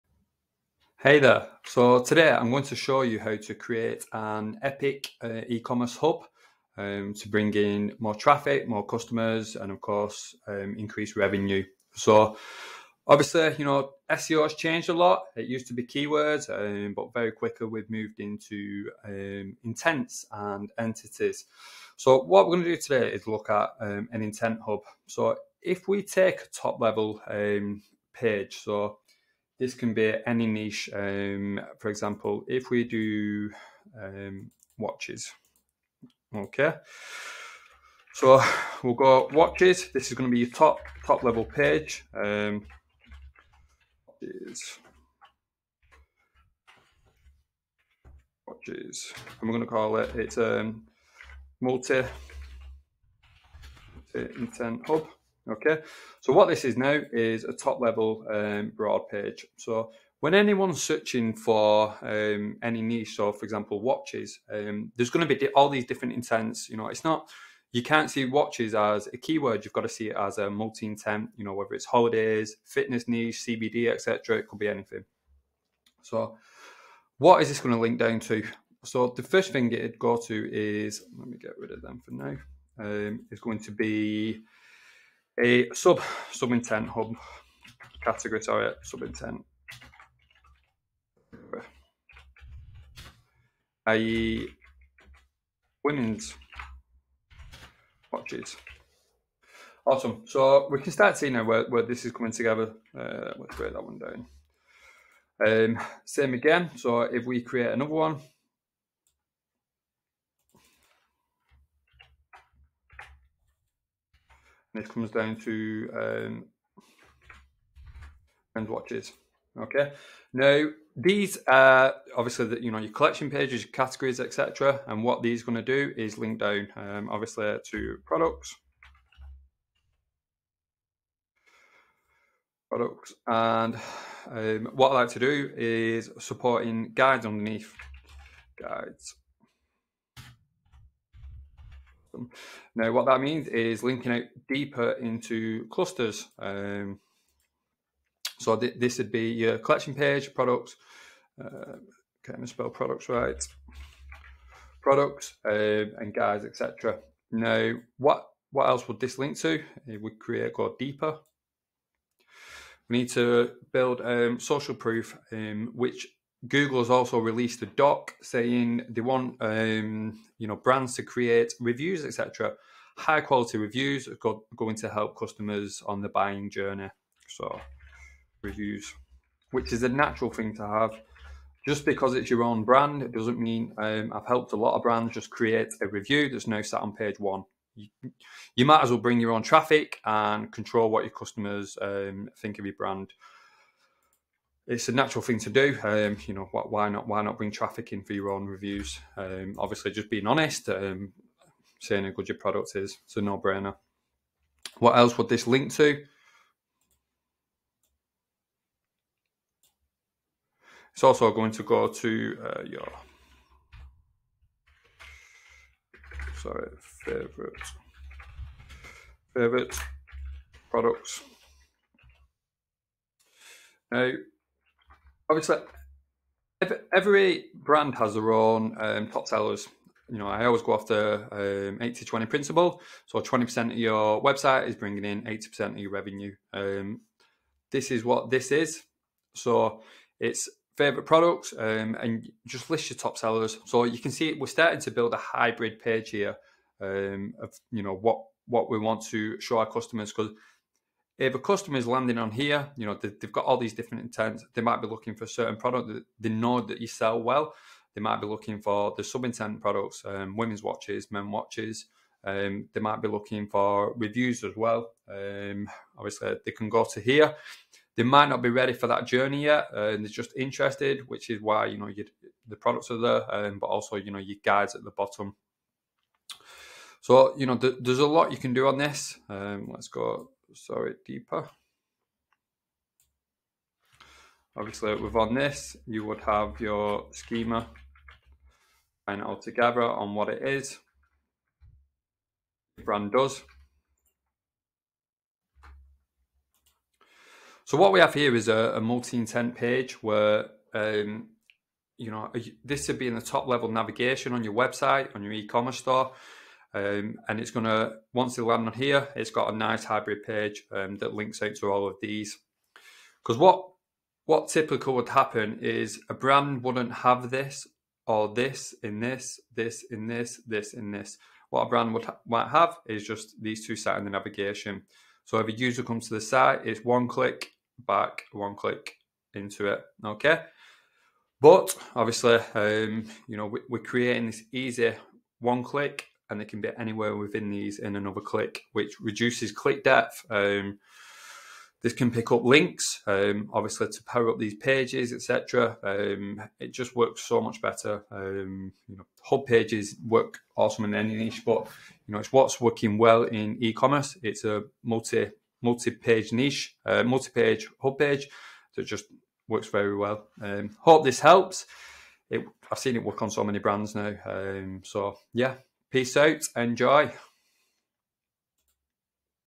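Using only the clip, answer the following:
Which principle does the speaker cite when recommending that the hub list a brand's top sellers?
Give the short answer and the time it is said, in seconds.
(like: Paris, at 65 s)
80 20 principle, at 231 s.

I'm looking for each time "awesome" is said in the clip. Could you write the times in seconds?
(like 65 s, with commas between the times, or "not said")
99 s, 350 s.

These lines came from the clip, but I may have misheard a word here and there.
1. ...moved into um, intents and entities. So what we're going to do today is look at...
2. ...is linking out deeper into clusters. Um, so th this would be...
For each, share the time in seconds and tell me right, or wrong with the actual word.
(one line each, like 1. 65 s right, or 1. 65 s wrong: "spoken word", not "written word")
1. 17 s right
2. 143 s right.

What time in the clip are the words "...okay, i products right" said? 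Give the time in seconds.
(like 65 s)
152 s.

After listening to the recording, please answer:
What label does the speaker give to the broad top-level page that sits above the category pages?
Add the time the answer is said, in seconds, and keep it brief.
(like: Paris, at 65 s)
Multi intent hub, at 54 s.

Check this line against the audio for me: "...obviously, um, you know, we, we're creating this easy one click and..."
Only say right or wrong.
right.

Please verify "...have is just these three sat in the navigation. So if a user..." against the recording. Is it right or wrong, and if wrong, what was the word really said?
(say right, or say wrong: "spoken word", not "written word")
wrong: "two", not "three".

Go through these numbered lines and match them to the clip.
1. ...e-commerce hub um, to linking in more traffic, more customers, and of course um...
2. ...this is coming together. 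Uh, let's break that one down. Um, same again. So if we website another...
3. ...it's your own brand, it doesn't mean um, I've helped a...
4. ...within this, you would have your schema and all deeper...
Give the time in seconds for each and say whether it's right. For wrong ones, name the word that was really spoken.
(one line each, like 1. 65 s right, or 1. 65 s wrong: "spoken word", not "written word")
1. 5 s wrong: "bring", not "linking"
2. 101 s wrong: "create", not "website"
3. 182 s right
4. 284 s wrong: "together", not "deeper".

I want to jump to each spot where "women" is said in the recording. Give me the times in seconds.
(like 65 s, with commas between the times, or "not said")
95 s, 260 s.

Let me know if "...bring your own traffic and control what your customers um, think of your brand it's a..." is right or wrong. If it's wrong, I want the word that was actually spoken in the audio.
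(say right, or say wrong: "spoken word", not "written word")
right.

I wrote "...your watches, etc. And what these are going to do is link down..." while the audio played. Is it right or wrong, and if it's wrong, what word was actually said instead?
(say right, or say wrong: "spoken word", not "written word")
wrong: "categories", not "watches".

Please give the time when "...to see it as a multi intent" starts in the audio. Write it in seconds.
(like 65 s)
69 s.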